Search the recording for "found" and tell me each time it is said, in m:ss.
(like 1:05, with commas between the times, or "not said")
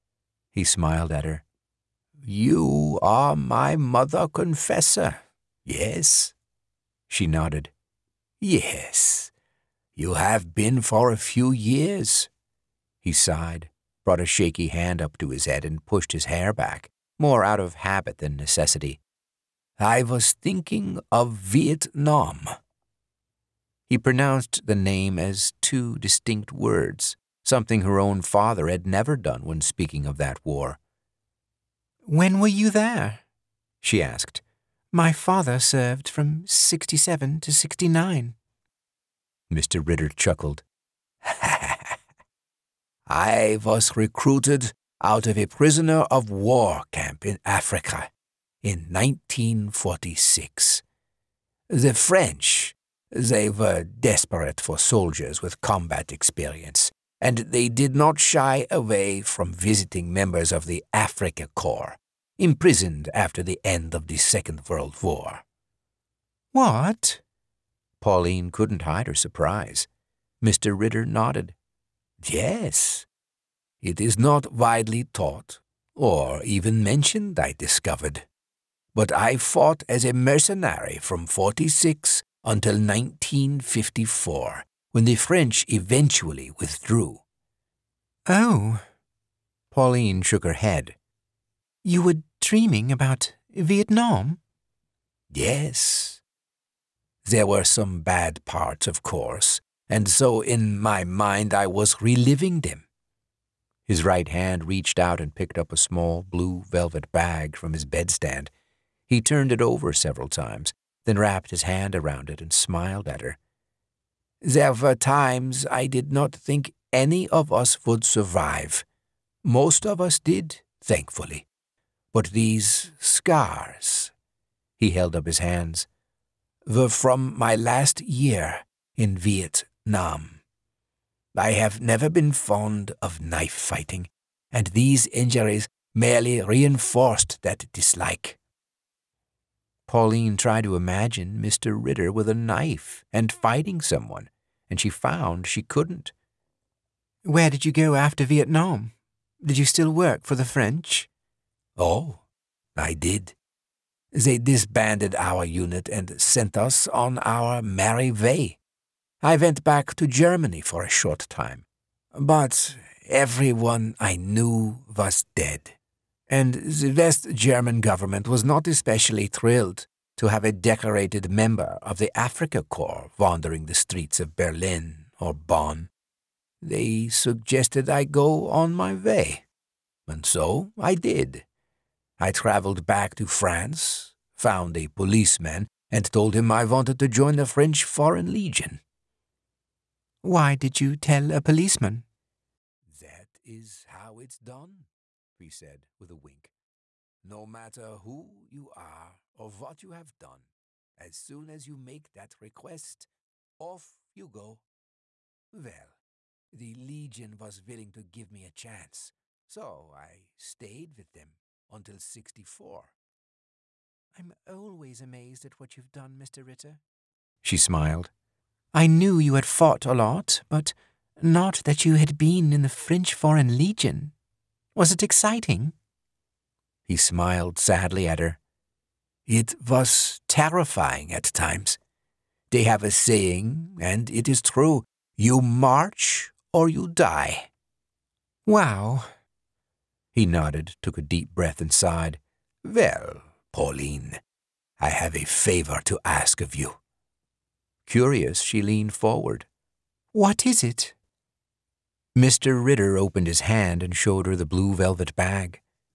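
2:24, 3:04.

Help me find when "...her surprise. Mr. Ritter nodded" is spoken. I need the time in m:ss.
1:09.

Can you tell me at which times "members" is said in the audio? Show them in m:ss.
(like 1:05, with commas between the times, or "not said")
1:00, 2:51.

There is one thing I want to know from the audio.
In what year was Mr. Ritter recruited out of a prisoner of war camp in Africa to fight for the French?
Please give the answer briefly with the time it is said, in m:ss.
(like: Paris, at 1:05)
1946, at 0:48.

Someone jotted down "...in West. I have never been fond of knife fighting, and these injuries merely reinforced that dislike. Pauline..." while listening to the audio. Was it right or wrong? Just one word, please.
wrong.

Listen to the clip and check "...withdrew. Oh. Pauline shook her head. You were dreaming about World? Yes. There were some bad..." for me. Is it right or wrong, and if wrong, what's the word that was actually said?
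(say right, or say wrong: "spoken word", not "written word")
wrong: "Vietnam", not "World".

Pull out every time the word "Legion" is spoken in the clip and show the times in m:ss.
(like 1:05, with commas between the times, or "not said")
3:08, 3:26, 3:43.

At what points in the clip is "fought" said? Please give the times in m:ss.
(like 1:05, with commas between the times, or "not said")
1:19, 3:39.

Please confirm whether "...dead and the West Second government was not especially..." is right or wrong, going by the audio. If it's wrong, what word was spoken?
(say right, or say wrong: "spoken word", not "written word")
wrong: "German", not "Second".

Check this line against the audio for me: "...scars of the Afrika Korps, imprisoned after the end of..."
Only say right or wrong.
wrong.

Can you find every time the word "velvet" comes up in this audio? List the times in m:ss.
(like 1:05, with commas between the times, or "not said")
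1:46, 4:14.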